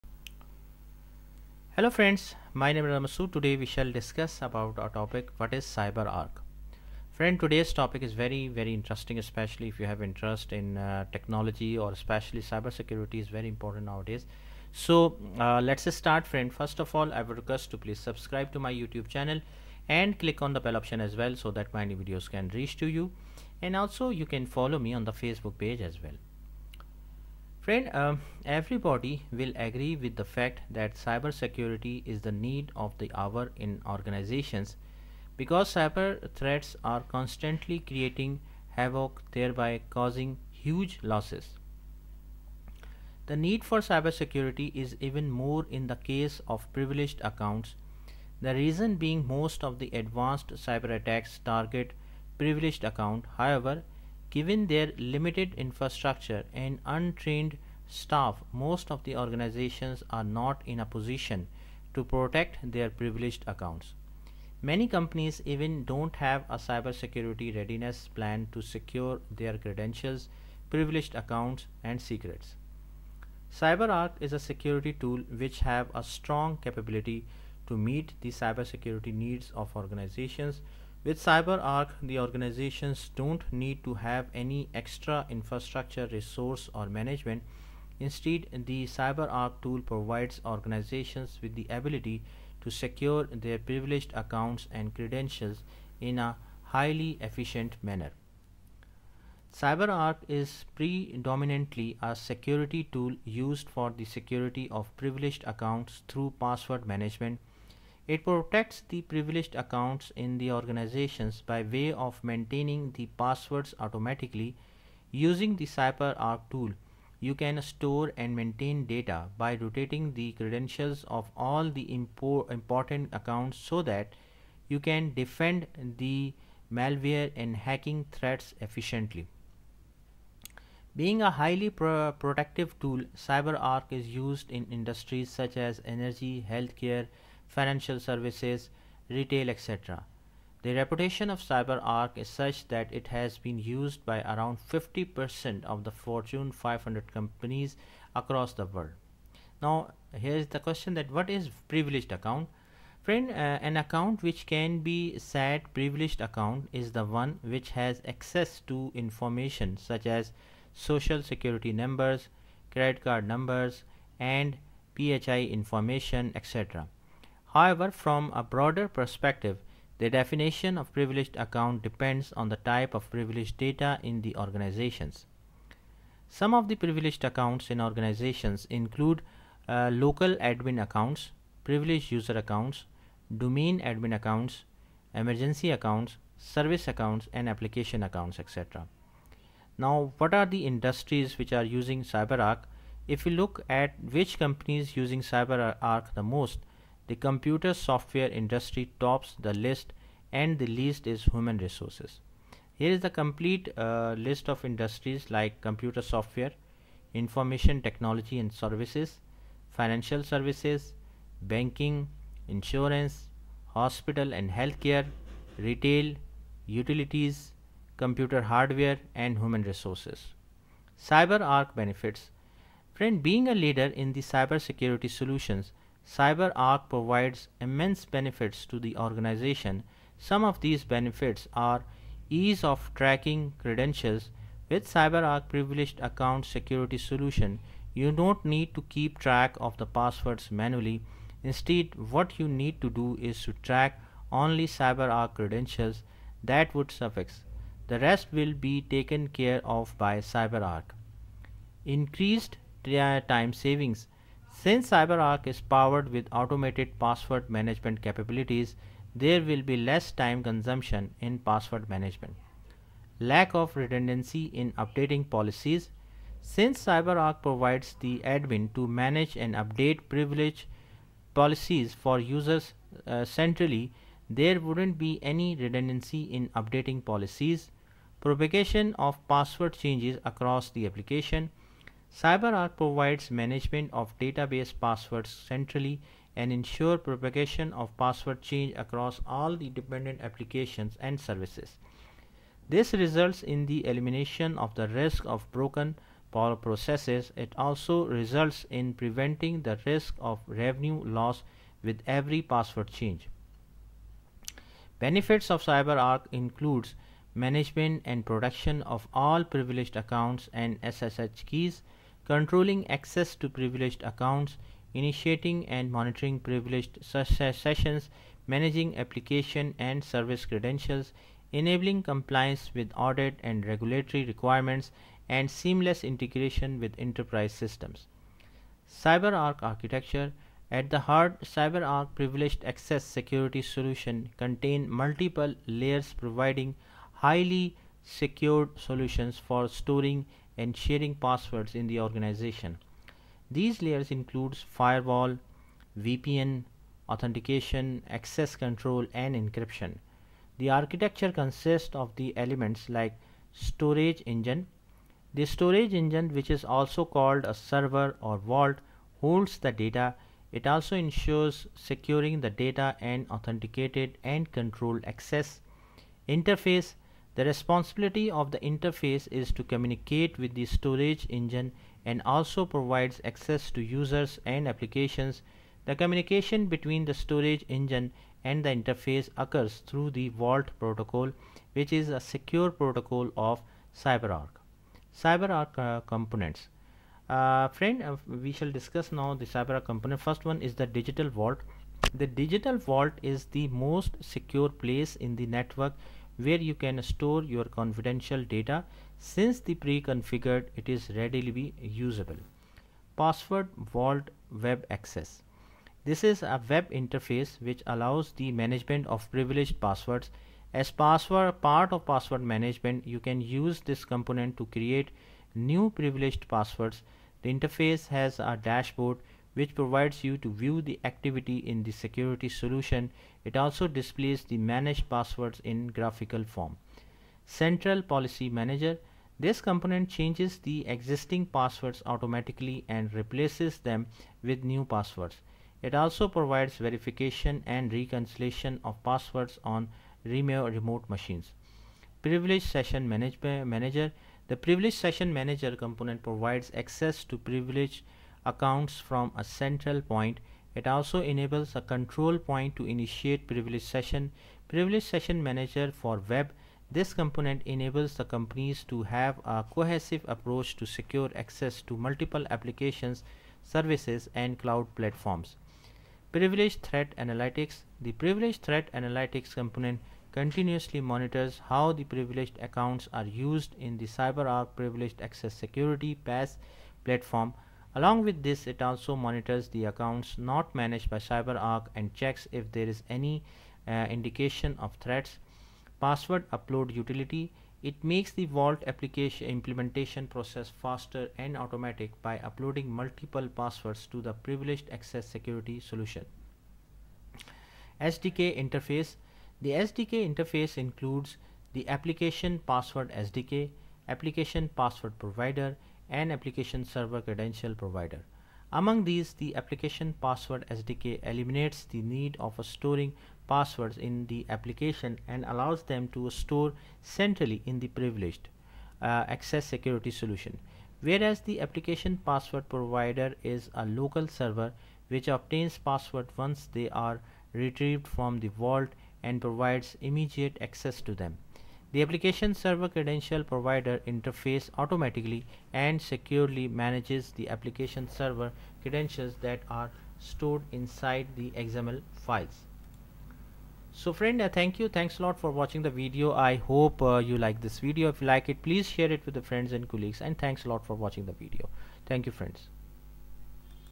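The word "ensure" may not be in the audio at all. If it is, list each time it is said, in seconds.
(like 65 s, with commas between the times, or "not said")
286 s, 360 s.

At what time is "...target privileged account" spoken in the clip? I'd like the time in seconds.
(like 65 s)
51 s.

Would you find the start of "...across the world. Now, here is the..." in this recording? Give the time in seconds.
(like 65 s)
148 s.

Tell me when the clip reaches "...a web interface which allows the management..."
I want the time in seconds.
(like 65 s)
406 s.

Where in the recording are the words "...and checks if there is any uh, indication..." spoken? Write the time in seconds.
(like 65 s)
481 s.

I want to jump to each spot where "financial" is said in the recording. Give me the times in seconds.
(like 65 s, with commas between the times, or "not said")
137 s, 209 s.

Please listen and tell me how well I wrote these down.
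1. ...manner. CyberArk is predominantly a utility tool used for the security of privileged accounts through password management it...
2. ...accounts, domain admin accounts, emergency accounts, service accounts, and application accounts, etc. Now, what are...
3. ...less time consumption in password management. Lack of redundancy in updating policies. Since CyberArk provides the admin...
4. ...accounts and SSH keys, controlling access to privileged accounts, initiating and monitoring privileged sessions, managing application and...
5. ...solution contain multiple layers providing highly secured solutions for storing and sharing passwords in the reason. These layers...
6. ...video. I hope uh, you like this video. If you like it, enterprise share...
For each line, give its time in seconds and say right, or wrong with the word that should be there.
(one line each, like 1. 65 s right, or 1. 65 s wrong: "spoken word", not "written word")
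1. 97 s wrong: "security", not "utility"
2. 182 s right
3. 259 s right
4. 309 s right
5. 333 s wrong: "organization", not "reason"
6. 545 s wrong: "please", not "enterprise".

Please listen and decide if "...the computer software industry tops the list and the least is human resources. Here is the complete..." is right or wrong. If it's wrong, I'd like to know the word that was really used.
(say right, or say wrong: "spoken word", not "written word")
right.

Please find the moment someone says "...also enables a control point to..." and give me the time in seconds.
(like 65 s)
450 s.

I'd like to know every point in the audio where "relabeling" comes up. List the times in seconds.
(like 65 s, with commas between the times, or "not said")
not said.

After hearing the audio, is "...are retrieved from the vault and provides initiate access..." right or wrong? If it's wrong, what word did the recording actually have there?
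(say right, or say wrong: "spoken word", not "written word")
wrong: "immediate", not "initiate".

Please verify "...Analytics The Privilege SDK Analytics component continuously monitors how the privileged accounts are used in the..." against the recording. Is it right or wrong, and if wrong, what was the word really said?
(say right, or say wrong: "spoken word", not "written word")
wrong: "Threat", not "SDK".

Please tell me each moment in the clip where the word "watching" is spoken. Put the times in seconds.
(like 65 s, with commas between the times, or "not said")
545 s, 550 s.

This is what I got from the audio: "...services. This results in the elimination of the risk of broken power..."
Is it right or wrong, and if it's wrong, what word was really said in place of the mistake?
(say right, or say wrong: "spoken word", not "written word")
right.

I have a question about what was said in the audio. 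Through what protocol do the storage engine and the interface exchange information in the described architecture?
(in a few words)
Vault protocol.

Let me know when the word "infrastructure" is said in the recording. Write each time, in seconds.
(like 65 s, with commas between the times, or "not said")
55 s, 85 s.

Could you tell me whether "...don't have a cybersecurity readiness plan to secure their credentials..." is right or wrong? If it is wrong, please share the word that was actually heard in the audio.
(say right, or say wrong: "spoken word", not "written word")
right.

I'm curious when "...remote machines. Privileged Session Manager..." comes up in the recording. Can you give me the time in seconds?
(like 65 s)
440 s.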